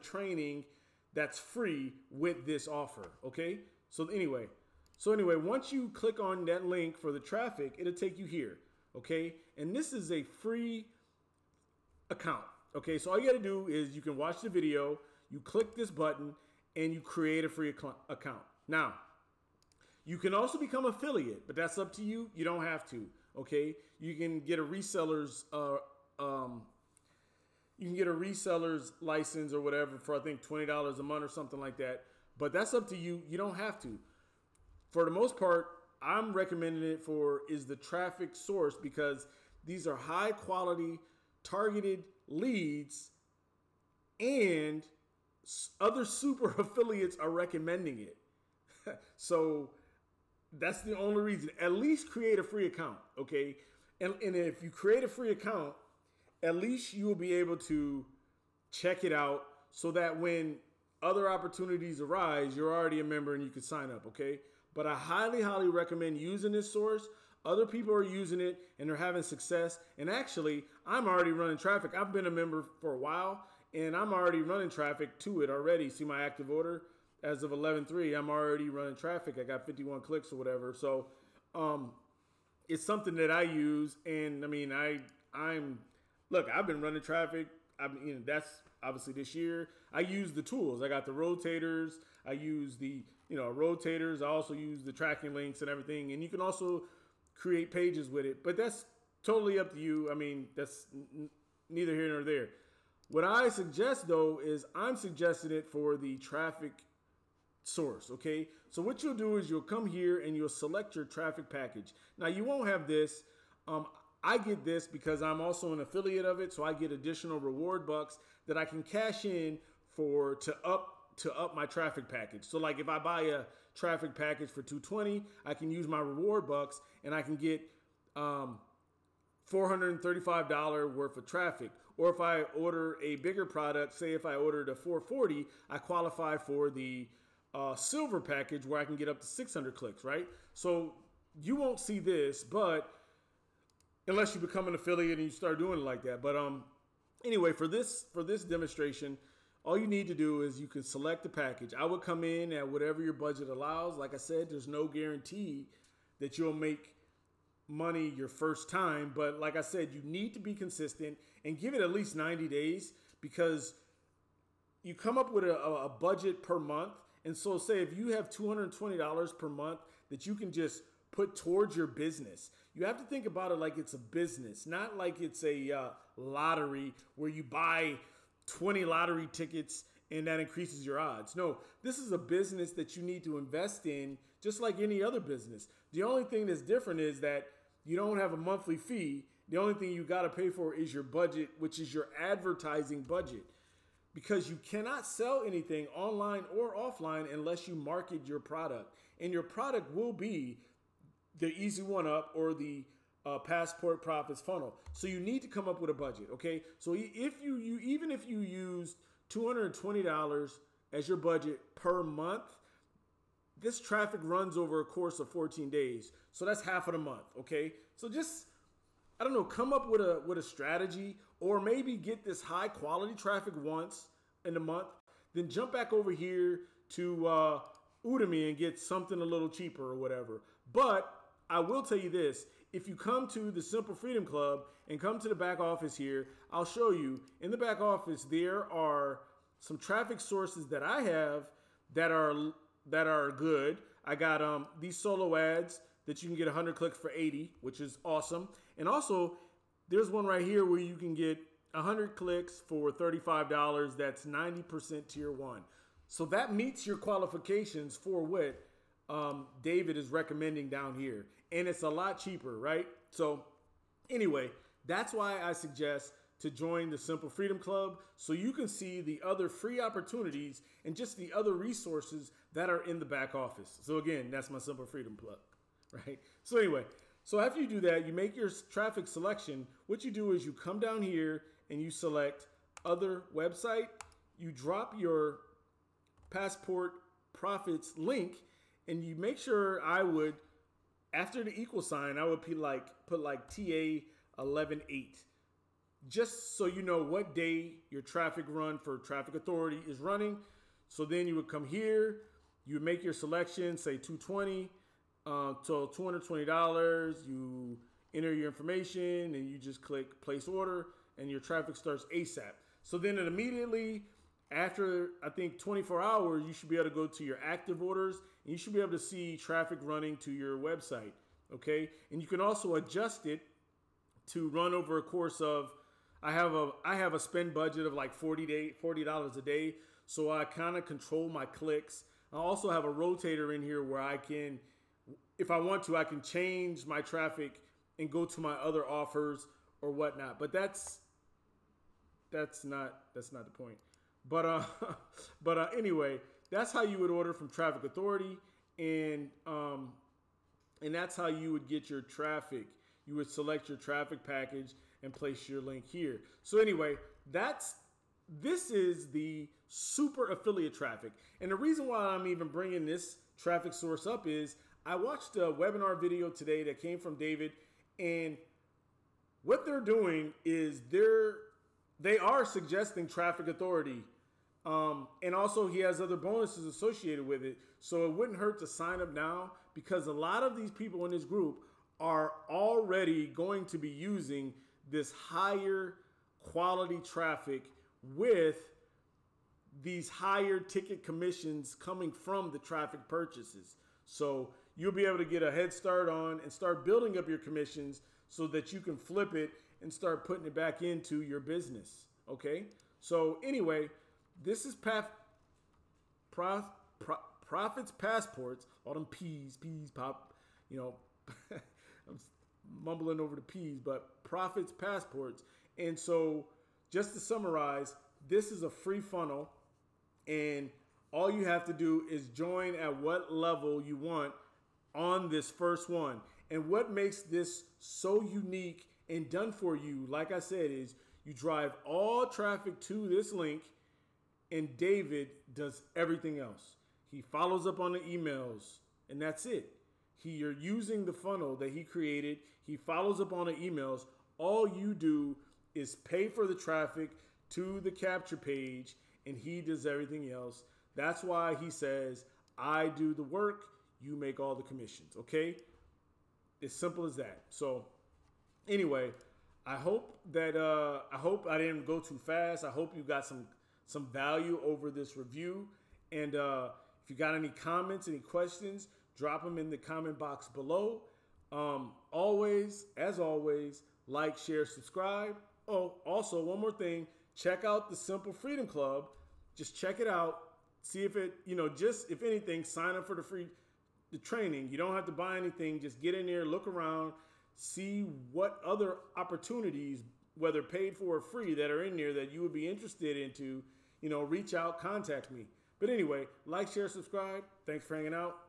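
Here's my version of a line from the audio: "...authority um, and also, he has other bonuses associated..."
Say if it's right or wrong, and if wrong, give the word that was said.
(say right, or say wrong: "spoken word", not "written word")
right.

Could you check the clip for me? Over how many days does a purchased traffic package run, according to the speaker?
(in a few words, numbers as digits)
14 days.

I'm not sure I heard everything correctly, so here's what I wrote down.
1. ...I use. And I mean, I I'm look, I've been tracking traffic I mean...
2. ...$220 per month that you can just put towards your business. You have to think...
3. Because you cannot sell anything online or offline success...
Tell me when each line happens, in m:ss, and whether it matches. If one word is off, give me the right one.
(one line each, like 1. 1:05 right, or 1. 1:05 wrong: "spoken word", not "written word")
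1. 1:23 wrong: "running", not "tracking"
2. 2:48 right
3. 3:14 wrong: "unless", not "success".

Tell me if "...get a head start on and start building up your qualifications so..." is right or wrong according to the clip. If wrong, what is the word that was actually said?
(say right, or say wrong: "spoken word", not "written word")
wrong: "commissions", not "qualifications".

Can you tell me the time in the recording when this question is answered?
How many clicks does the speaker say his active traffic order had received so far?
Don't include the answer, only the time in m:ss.
1:19.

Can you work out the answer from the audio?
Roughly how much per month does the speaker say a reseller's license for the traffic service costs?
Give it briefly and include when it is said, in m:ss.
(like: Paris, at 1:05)
$20, at 0:30.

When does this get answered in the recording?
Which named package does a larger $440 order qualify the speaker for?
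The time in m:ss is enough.
2:17.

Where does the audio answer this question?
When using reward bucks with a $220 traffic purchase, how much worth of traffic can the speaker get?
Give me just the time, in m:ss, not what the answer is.
2:09.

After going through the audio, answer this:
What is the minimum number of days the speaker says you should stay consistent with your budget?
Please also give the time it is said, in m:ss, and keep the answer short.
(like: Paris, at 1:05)
90 days, at 2:42.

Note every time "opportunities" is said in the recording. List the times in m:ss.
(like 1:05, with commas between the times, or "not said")
1:01, 4:29, 8:09.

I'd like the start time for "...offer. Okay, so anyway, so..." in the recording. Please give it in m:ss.
0:02.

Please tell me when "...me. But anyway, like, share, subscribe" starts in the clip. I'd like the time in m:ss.
8:15.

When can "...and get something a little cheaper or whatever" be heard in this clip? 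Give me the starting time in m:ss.
3:48.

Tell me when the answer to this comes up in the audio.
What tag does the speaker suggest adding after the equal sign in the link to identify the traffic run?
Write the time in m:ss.
4:53.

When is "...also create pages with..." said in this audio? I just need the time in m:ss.
1:36.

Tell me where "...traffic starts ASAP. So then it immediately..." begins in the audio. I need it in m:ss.
5:11.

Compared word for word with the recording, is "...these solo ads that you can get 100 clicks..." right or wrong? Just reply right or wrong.
right.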